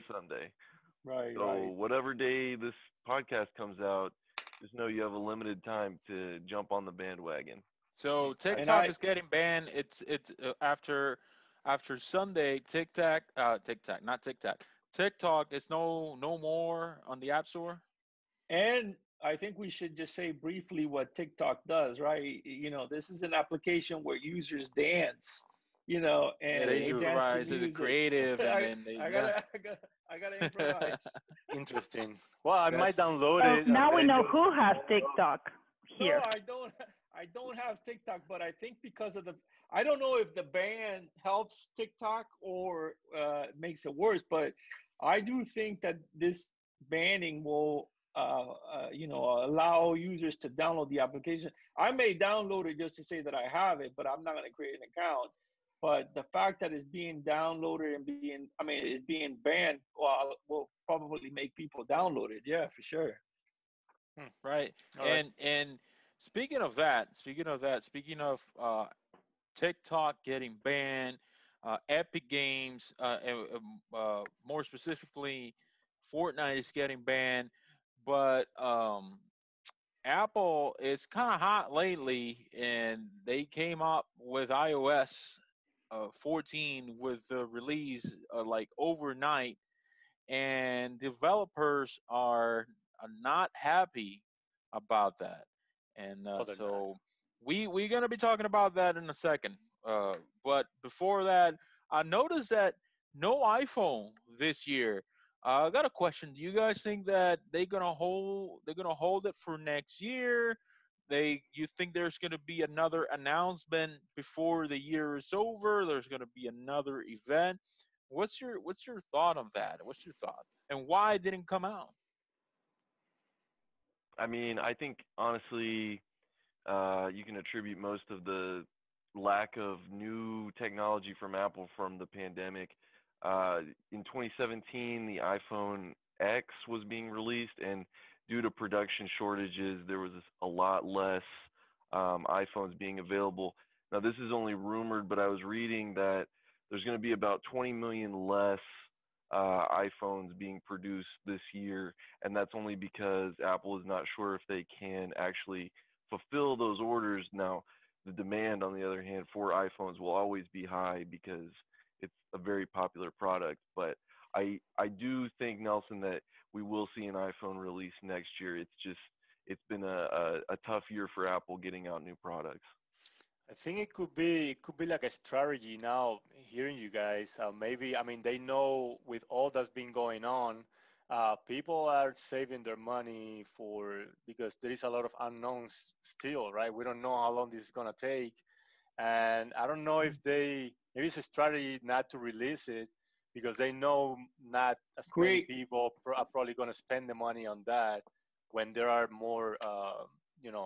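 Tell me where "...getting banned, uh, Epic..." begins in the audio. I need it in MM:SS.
01:10.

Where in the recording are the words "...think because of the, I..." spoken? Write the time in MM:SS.
00:38.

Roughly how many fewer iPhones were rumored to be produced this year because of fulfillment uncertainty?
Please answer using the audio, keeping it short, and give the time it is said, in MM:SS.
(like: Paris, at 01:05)
20 million, at 02:27.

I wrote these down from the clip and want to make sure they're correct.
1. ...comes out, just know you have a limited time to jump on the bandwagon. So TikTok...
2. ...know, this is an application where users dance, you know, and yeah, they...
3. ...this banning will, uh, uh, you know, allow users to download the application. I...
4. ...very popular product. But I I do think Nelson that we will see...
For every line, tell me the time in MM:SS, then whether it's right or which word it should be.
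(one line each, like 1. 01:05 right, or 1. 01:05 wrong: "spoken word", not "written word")
1. 00:03 right
2. 00:22 right
3. 00:46 right
4. 02:42 right.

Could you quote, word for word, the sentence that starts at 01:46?
Do you guys think that they're gonna hold they're gonna hold it for next year?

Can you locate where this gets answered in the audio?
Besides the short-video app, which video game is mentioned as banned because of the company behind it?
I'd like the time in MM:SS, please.
01:16.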